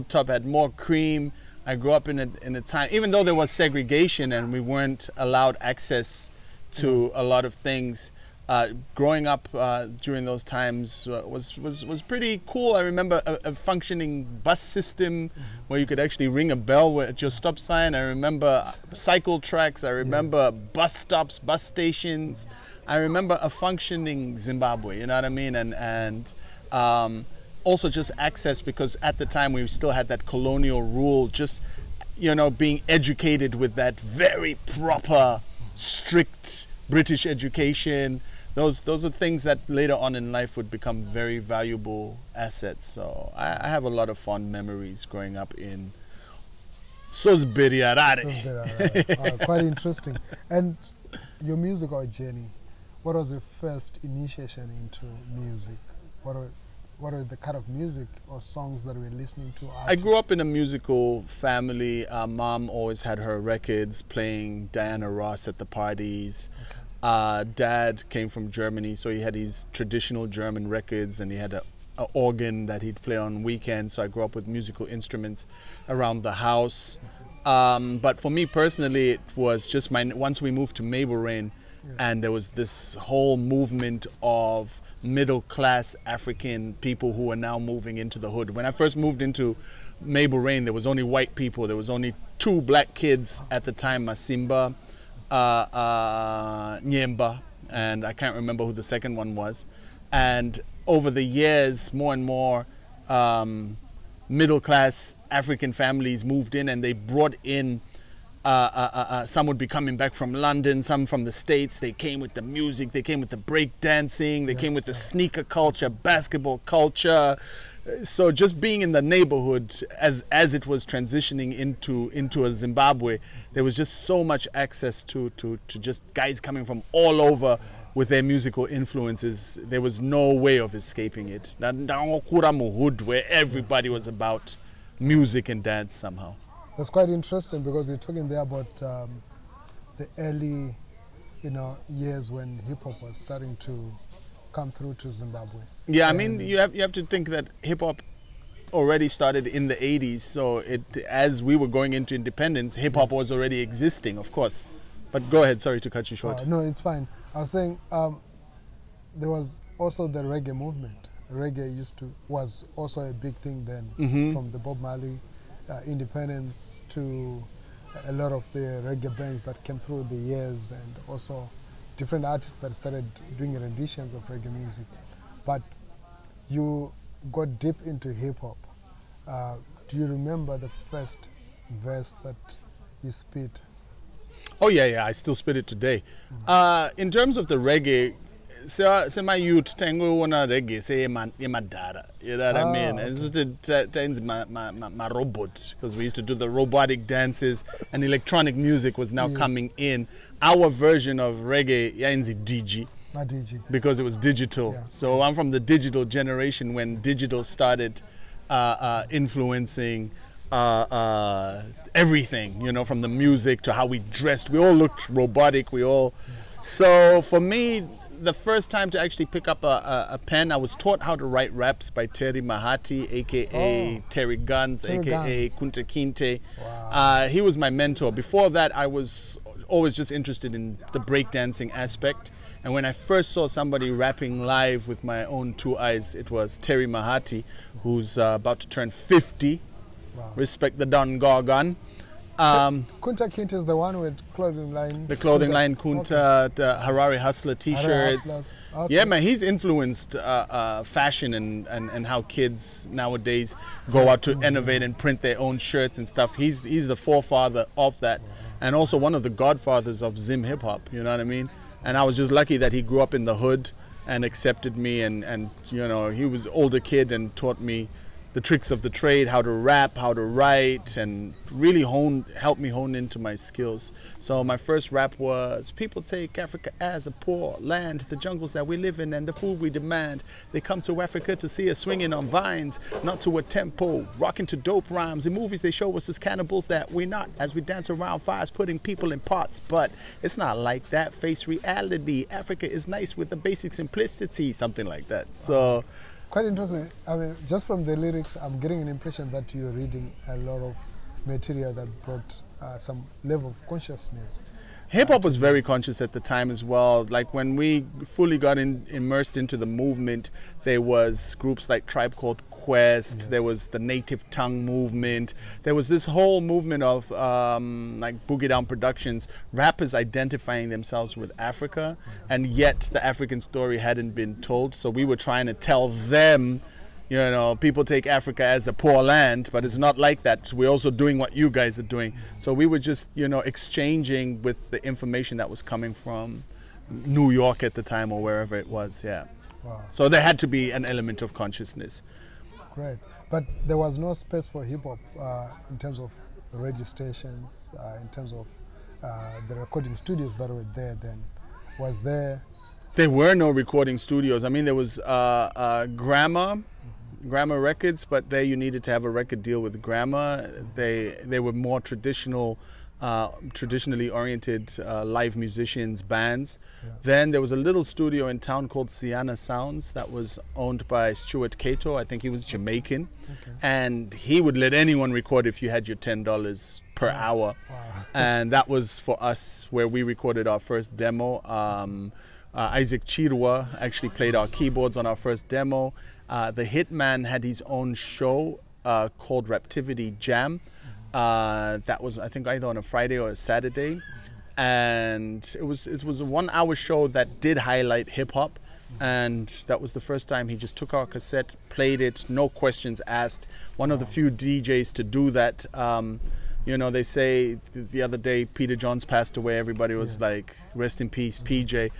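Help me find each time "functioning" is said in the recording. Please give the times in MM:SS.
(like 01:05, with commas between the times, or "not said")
00:13, 00:23.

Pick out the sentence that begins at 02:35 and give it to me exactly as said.
But go ahead, sorry to cut you short.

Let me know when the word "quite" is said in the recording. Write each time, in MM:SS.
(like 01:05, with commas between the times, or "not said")
00:49, 02:16, 04:56.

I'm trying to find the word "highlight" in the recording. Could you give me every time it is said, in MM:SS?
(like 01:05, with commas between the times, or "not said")
06:37.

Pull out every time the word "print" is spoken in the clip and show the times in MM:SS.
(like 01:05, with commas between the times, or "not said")
04:14.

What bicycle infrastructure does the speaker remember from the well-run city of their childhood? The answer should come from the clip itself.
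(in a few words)
cycle tracks.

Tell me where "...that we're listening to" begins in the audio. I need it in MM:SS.
00:58.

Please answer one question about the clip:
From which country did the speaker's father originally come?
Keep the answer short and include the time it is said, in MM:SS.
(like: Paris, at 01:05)
Germany, at 01:08.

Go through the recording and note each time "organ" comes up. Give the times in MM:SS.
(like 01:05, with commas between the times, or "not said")
01:12.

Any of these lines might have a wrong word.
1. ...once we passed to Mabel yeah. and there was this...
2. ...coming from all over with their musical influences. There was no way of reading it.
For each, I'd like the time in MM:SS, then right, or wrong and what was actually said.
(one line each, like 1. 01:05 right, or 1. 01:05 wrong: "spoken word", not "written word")
1. 01:20 wrong: "moved", not "passed"
2. 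02:06 wrong: "escaping", not "reading".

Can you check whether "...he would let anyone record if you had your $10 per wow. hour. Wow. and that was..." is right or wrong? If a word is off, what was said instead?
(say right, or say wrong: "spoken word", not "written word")
right.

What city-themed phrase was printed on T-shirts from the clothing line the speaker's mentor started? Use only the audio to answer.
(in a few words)
Harare Hustler.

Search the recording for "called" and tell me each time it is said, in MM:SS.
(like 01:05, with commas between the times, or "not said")
05:12, 06:08, 06:29.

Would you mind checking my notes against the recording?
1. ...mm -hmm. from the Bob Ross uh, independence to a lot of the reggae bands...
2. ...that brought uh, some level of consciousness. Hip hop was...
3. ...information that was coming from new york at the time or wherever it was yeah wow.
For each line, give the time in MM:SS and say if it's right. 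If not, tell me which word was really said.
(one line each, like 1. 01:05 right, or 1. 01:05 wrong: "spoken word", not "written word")
1. 02:43 wrong: "Marley", not "Ross"
2. 05:01 right
3. 05:34 right.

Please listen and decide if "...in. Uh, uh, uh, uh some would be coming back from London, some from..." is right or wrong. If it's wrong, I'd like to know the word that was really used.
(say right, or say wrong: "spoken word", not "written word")
right.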